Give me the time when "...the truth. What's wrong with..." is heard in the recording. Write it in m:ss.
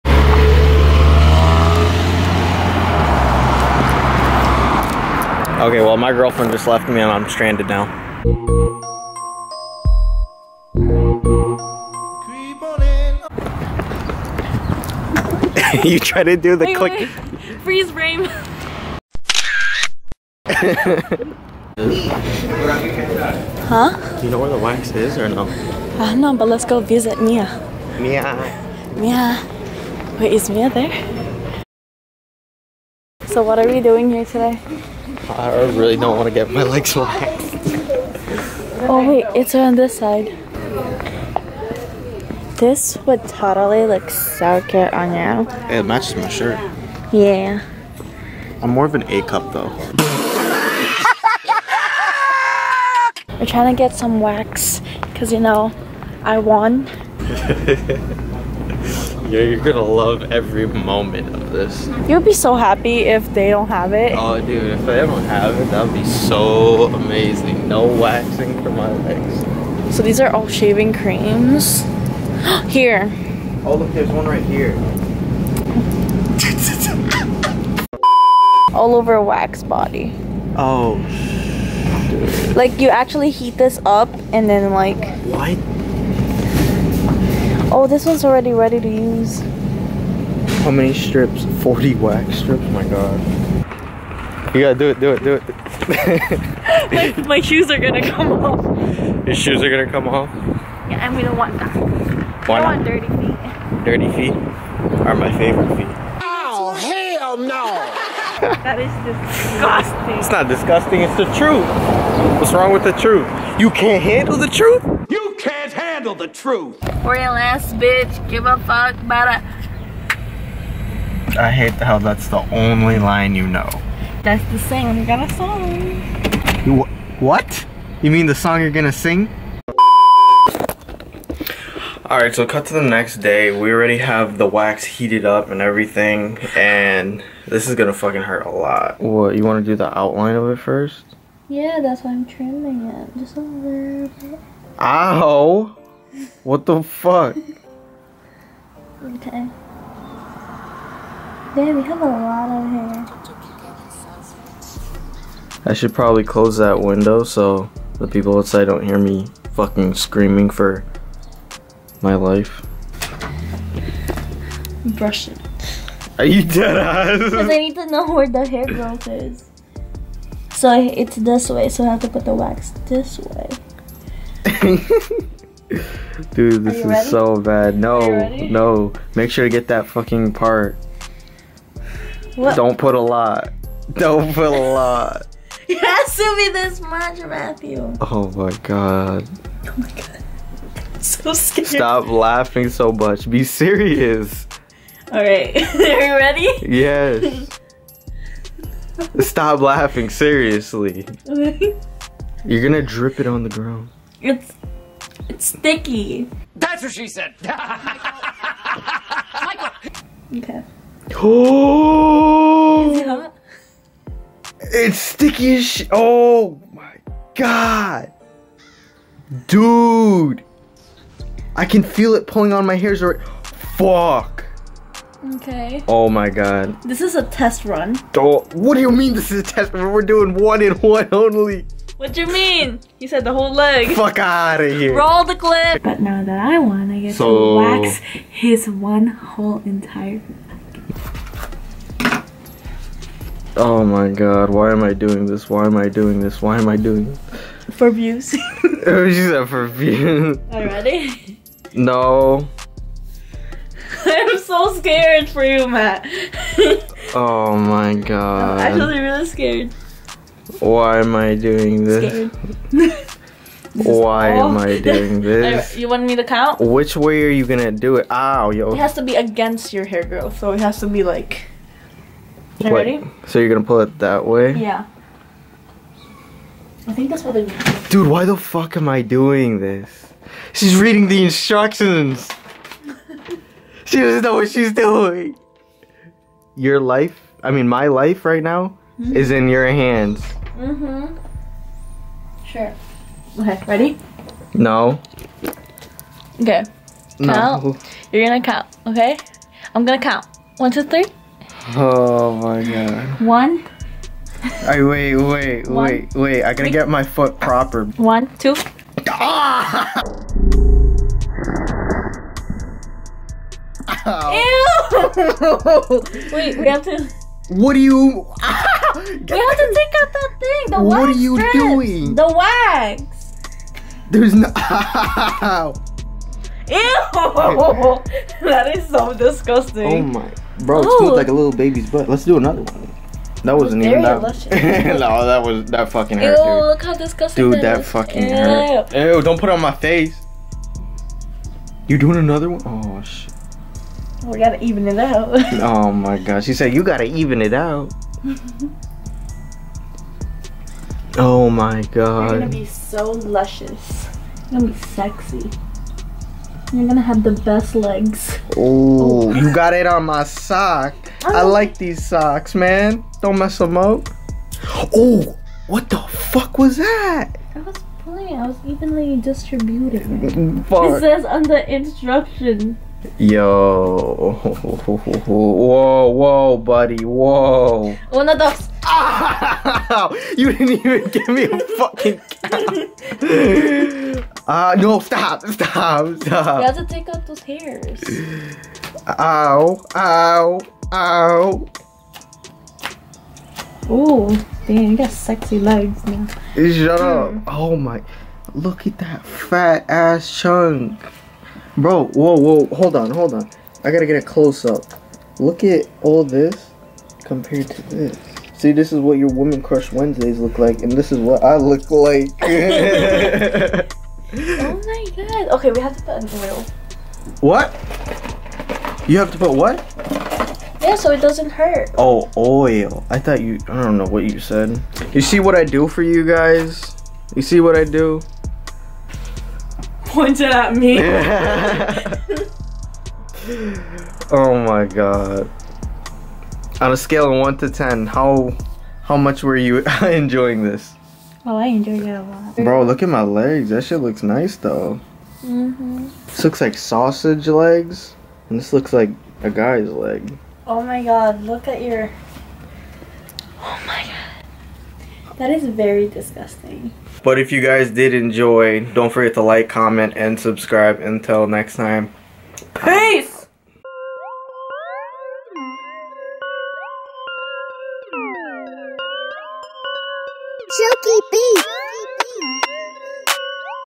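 1:51.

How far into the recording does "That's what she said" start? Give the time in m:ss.
3:26.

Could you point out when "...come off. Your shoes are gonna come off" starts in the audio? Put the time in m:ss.
1:38.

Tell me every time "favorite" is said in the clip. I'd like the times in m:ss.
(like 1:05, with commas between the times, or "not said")
1:45.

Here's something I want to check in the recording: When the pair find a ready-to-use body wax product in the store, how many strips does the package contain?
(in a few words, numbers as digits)
40.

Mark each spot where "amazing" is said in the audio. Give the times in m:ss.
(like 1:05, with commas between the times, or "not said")
1:06.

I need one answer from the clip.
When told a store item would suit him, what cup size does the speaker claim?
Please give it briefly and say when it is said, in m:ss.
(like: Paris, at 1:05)
A cup, at 0:49.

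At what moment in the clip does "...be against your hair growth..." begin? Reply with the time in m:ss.
4:29.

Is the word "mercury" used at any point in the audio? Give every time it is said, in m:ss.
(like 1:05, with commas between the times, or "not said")
not said.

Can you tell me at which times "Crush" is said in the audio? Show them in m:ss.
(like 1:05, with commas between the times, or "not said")
6:49.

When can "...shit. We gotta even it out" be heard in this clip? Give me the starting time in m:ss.
5:43.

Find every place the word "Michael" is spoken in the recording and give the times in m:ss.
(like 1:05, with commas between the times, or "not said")
3:27.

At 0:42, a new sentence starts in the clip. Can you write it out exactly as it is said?
This would totally look so good on you.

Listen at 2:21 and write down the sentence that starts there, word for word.
Yeah, that's why I'm trimming it.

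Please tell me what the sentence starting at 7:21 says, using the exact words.
Well, I enjoyed it a lot.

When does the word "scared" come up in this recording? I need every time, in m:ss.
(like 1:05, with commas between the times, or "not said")
3:11, 4:14, 4:19.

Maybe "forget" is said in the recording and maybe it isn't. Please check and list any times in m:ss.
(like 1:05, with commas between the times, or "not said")
7:39.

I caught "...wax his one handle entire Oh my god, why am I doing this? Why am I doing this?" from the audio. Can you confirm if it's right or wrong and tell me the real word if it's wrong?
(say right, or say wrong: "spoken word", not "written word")
wrong: "whole", not "handle".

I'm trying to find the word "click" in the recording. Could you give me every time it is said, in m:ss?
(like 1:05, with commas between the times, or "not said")
0:16.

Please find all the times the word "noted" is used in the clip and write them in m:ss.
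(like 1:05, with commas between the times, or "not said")
not said.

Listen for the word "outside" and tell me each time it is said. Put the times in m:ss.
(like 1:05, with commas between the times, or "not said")
2:38.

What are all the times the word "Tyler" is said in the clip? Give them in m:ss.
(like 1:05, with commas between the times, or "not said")
not said.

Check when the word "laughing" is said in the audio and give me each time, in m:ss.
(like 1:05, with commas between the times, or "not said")
3:12, 3:19.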